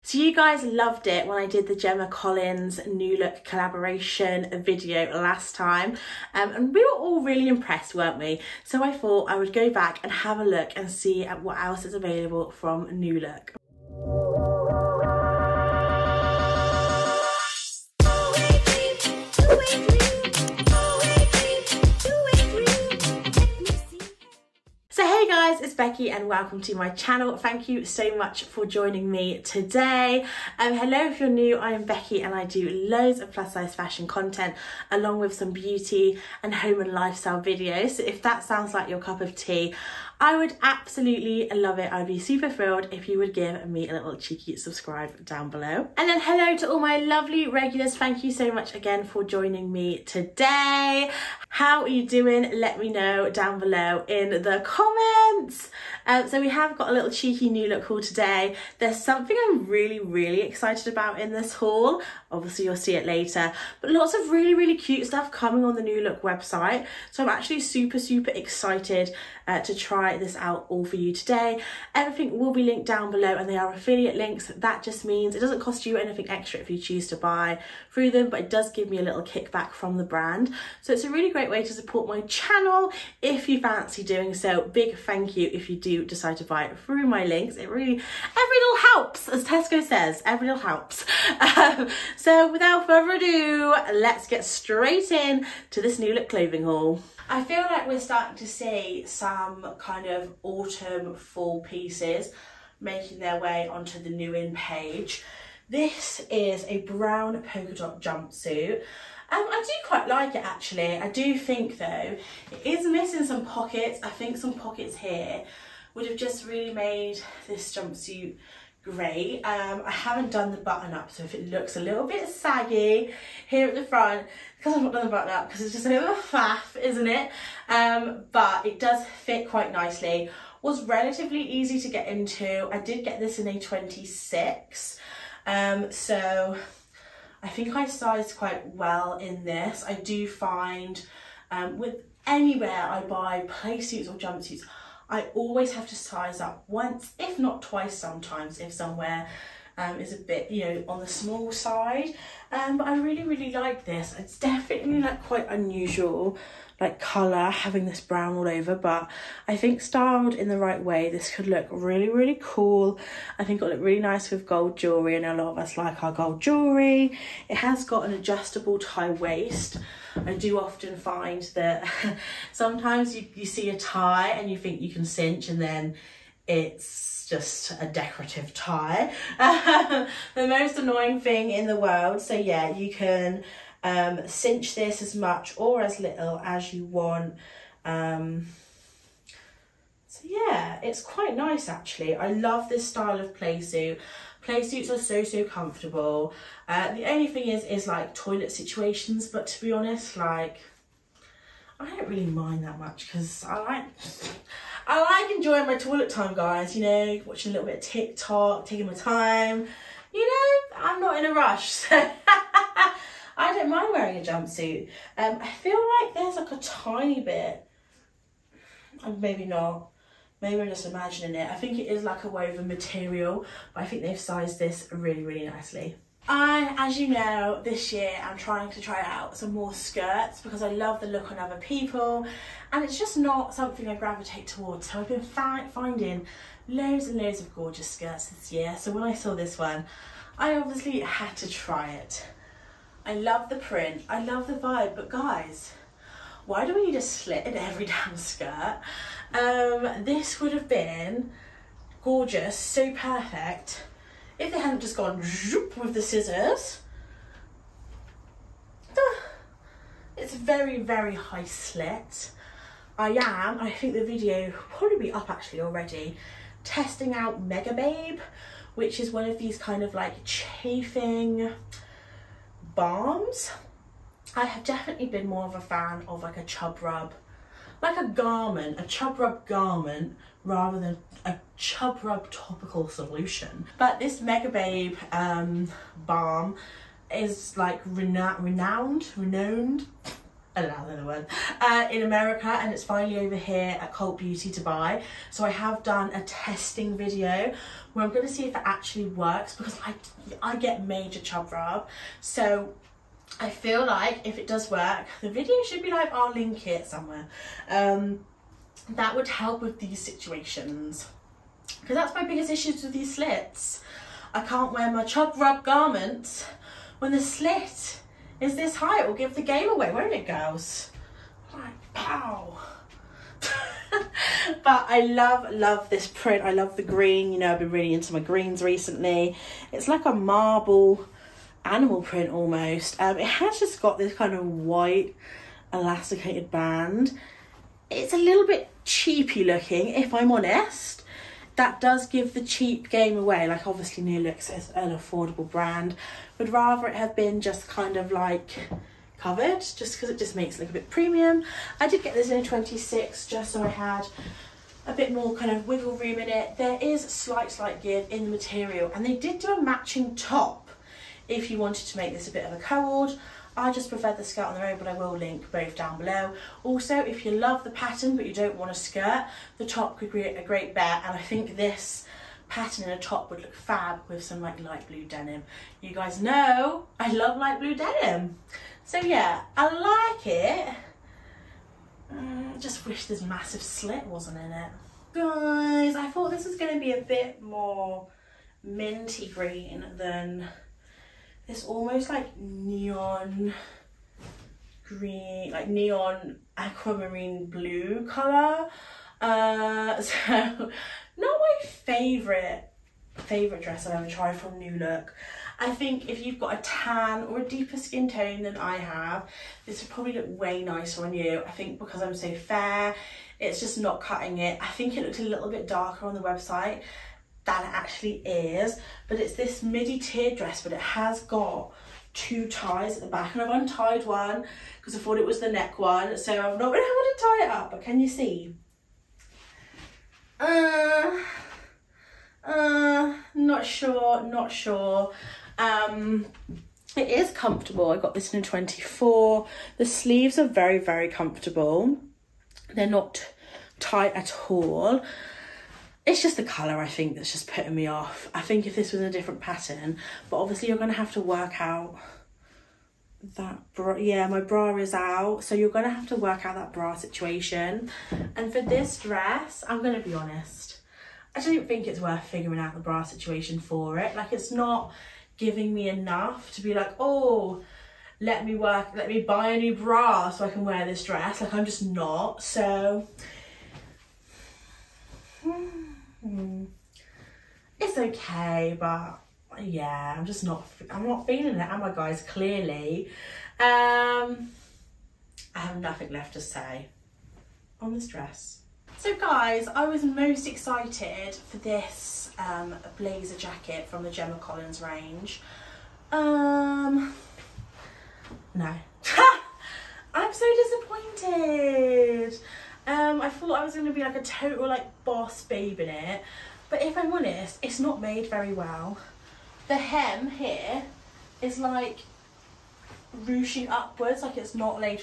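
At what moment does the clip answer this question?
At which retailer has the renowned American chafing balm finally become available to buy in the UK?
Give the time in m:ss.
4:53.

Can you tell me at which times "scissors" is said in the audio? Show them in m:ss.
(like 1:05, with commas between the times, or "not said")
4:16.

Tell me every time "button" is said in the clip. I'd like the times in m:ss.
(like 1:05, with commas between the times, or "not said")
2:00, 2:05.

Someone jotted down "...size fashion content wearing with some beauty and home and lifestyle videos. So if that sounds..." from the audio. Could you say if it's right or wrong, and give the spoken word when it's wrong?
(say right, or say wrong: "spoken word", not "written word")
wrong: "along", not "wearing".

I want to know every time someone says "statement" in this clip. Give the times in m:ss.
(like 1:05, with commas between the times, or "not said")
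not said.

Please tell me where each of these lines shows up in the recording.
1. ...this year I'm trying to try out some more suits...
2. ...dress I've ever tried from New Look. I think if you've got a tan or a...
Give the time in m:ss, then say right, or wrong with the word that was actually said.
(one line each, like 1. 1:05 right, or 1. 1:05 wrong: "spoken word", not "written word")
1. 3:47 wrong: "skirts", not "suits"
2. 6:43 right.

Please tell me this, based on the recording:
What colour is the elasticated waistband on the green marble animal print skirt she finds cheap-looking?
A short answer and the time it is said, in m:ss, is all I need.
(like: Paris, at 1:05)
white, at 5:34.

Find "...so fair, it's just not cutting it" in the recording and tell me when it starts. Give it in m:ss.
6:52.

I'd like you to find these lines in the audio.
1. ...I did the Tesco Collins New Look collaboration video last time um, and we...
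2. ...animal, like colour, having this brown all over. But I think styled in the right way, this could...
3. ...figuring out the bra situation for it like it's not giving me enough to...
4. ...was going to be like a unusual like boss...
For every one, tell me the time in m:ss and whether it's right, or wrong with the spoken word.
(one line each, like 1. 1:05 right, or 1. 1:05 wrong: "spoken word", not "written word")
1. 0:01 wrong: "Gemma", not "Tesco"
2. 2:35 wrong: "unusual", not "animal"
3. 7:42 right
4. 8:23 wrong: "total", not "unusual".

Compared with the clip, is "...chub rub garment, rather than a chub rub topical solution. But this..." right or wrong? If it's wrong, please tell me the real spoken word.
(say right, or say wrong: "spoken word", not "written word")
right.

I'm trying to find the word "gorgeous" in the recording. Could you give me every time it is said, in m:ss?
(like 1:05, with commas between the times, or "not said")
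3:57, 4:12.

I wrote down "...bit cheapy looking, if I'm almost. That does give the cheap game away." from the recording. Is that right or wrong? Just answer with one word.
wrong.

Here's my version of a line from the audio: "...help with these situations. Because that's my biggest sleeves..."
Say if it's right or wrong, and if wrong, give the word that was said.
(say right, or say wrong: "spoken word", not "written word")
wrong: "issues", not "sleeves".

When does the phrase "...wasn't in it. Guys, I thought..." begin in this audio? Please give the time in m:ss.
6:24.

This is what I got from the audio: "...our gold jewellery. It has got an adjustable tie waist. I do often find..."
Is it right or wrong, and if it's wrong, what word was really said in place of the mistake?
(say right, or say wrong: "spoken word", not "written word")
right.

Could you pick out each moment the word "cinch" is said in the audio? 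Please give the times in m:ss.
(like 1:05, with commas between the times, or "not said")
2:55, 3:04.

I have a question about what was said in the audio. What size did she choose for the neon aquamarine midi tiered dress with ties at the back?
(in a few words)
24.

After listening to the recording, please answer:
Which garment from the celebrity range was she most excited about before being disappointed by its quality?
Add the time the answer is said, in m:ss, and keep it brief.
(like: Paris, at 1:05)
blazer jacket, at 8:12.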